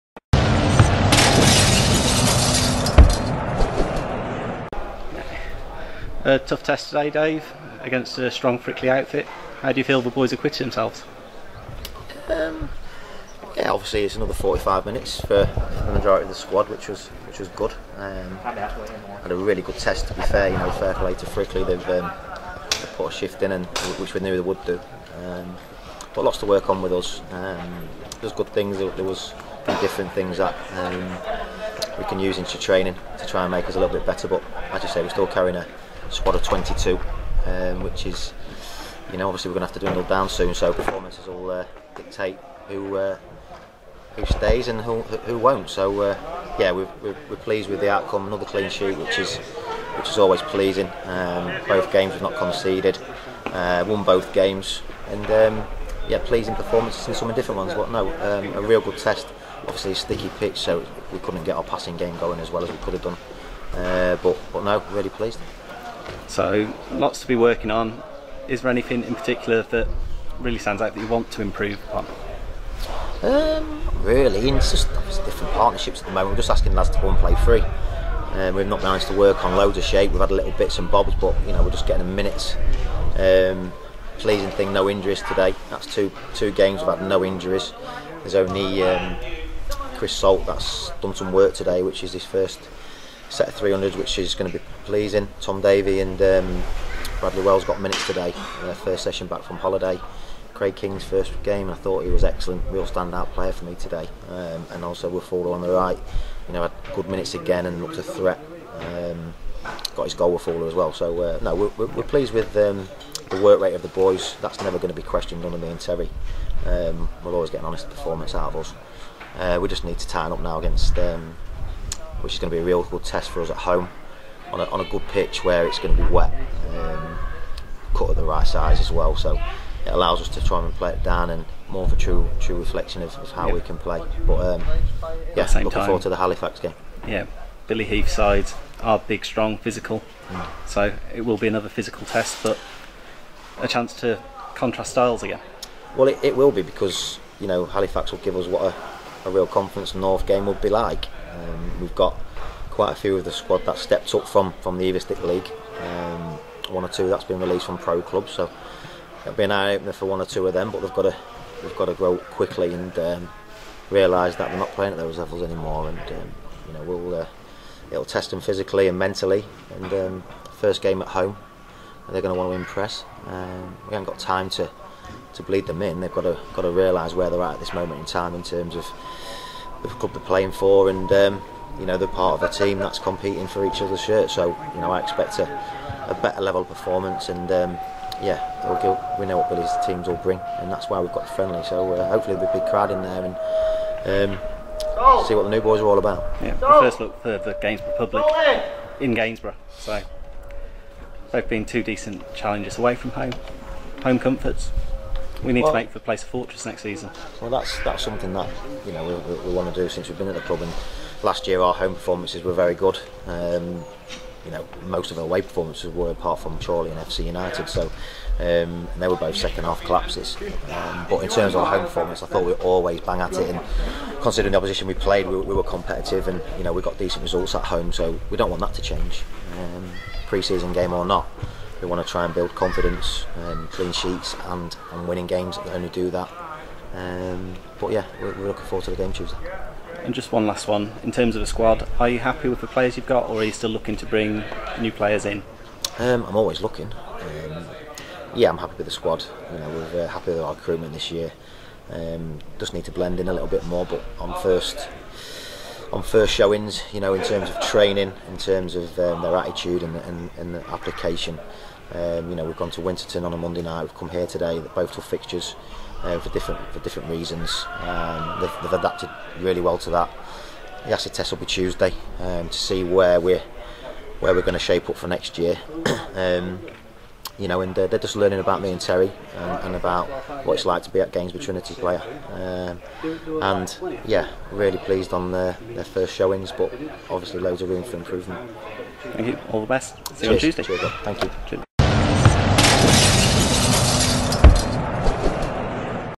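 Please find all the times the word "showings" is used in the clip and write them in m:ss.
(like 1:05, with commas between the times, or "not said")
4:16, 4:46.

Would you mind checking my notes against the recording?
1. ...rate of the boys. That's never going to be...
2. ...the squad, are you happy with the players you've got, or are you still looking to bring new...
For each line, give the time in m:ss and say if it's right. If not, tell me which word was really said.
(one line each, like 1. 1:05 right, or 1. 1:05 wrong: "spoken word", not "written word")
1. 1:53 right
2. 4:01 right.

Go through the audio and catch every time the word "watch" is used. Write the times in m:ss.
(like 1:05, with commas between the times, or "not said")
not said.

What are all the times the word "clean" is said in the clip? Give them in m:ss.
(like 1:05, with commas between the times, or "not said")
0:48, 3:53.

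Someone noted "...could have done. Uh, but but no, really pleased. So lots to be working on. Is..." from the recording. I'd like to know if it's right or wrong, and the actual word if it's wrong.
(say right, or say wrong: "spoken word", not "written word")
right.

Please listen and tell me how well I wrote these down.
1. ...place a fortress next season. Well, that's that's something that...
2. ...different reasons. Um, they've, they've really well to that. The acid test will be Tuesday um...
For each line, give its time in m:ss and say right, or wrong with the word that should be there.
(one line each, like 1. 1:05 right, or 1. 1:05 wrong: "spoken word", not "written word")
1. 3:25 right
2. 4:26 right.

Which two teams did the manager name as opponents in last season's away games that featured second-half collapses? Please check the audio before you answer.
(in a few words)
Chorley and FC United.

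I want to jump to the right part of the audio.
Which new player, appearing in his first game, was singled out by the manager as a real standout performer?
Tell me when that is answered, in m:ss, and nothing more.
1:40.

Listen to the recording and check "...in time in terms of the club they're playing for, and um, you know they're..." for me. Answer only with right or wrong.
right.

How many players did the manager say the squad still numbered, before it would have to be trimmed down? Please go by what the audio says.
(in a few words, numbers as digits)
22.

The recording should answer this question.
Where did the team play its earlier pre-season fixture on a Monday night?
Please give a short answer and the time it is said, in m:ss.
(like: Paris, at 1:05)
Winterton, at 4:22.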